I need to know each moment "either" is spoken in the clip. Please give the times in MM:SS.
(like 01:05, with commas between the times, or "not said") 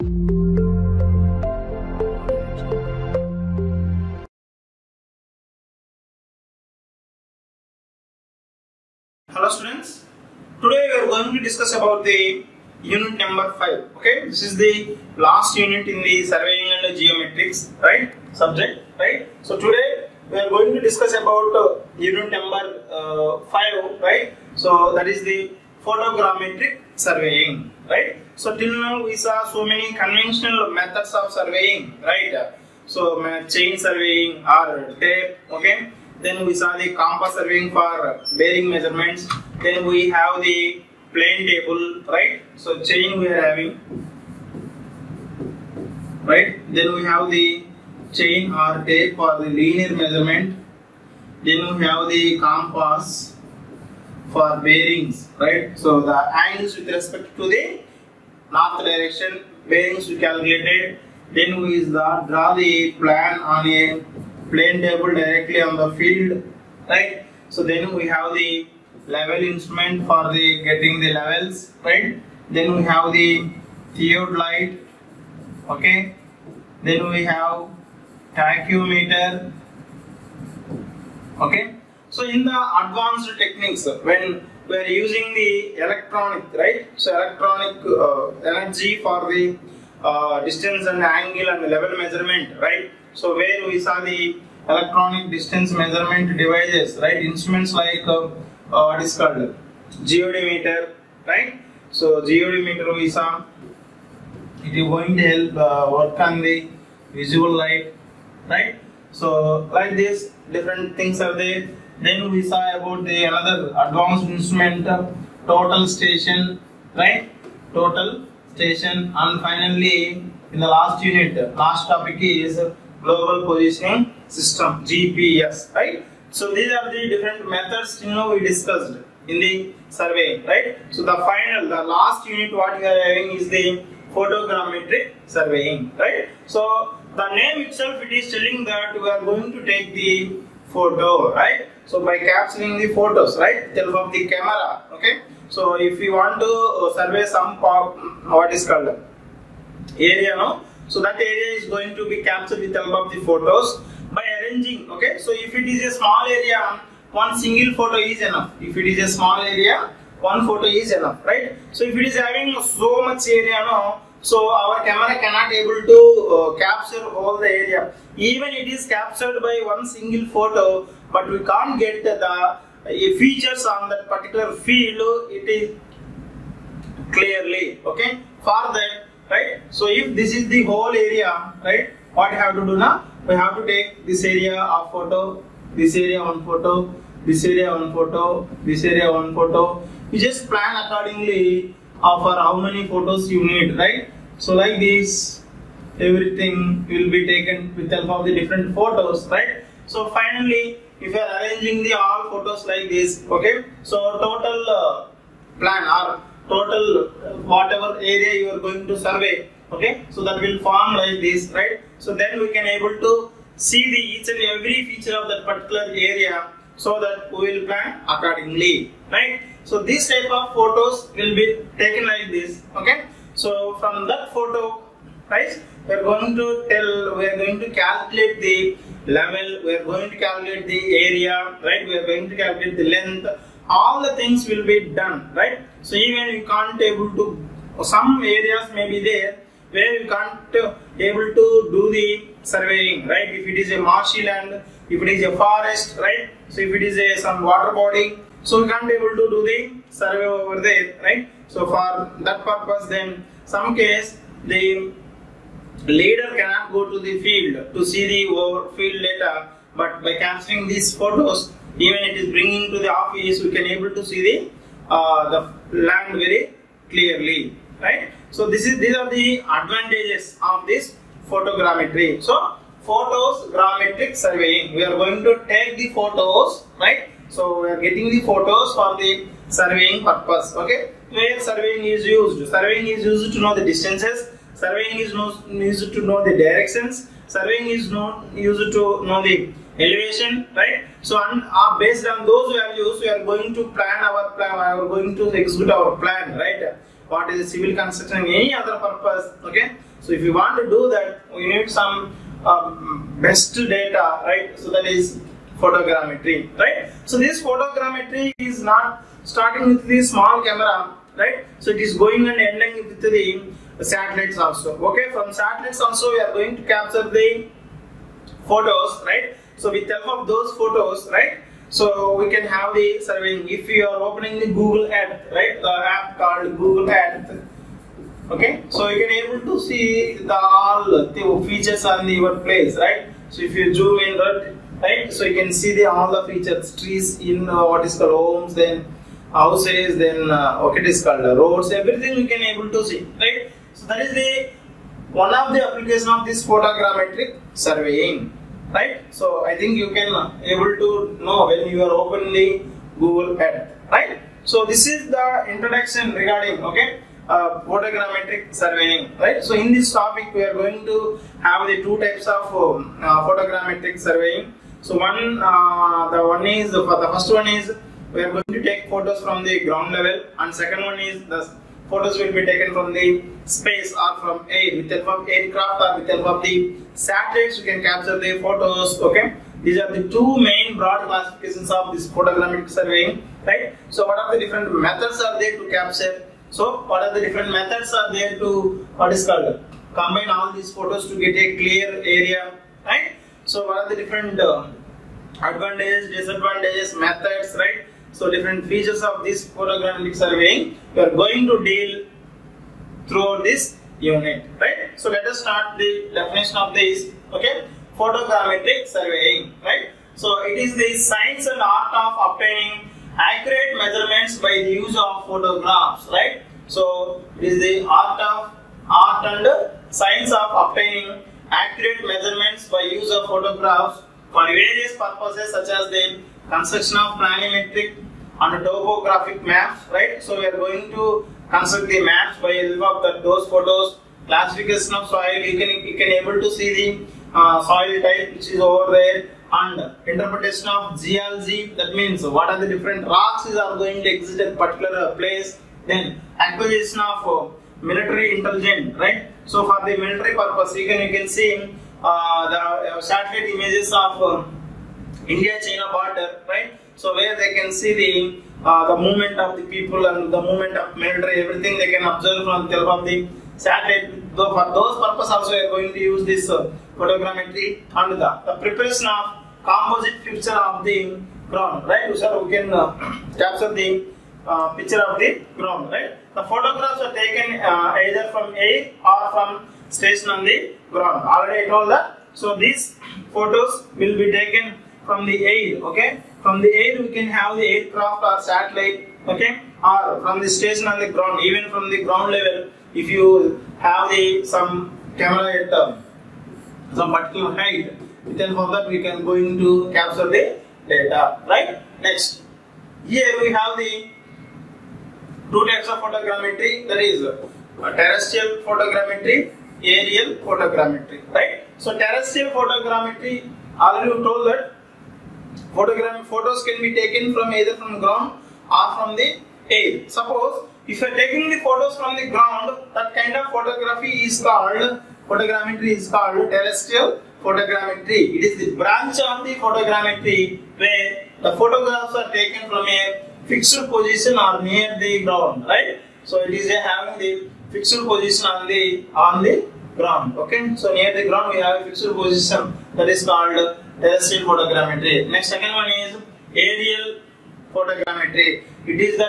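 07:58, 08:37.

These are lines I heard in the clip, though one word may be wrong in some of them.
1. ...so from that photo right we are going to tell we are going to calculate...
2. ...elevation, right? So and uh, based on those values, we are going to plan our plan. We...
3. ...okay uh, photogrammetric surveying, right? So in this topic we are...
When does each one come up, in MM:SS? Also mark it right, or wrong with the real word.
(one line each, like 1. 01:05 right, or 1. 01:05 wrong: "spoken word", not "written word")
1. 03:43 right
2. 04:49 right
3. 05:56 right.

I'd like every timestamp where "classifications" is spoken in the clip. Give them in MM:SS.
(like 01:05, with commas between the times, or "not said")
06:21, 07:14.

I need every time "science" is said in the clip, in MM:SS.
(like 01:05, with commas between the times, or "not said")
06:50, 06:59.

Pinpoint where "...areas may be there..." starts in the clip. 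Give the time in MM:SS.
03:58.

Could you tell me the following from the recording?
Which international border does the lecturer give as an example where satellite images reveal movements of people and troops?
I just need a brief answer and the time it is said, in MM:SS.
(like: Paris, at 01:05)
India-China border, at 07:35.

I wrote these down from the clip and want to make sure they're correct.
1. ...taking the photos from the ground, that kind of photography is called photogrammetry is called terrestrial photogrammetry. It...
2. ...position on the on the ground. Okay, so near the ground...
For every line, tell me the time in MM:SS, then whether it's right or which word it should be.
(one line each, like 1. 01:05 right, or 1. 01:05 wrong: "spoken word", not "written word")
1. 08:41 right
2. 08:58 right.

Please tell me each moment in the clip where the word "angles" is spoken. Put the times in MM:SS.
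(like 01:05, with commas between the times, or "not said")
00:56, 01:31.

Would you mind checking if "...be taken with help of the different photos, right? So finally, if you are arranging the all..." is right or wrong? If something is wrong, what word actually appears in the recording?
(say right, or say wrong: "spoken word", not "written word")
right.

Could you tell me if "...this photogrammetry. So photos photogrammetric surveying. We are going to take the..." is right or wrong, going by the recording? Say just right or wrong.
wrong.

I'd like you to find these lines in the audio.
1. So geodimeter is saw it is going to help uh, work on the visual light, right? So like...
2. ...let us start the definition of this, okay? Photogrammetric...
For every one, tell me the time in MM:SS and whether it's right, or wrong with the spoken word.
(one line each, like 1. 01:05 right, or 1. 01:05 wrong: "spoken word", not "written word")
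1. 01:41 right
2. 06:45 right.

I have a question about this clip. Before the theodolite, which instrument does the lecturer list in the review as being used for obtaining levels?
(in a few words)
Level instrument.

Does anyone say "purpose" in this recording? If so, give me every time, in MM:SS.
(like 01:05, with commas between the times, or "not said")
04:12, 04:40, 04:58, 07:04, 07:30, 07:45.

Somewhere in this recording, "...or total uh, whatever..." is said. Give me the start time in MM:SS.
03:25.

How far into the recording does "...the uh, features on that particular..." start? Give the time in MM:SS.
02:52.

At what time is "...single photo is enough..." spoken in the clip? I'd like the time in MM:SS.
02:37.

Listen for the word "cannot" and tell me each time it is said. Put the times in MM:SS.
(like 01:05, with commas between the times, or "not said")
02:45, 04:16.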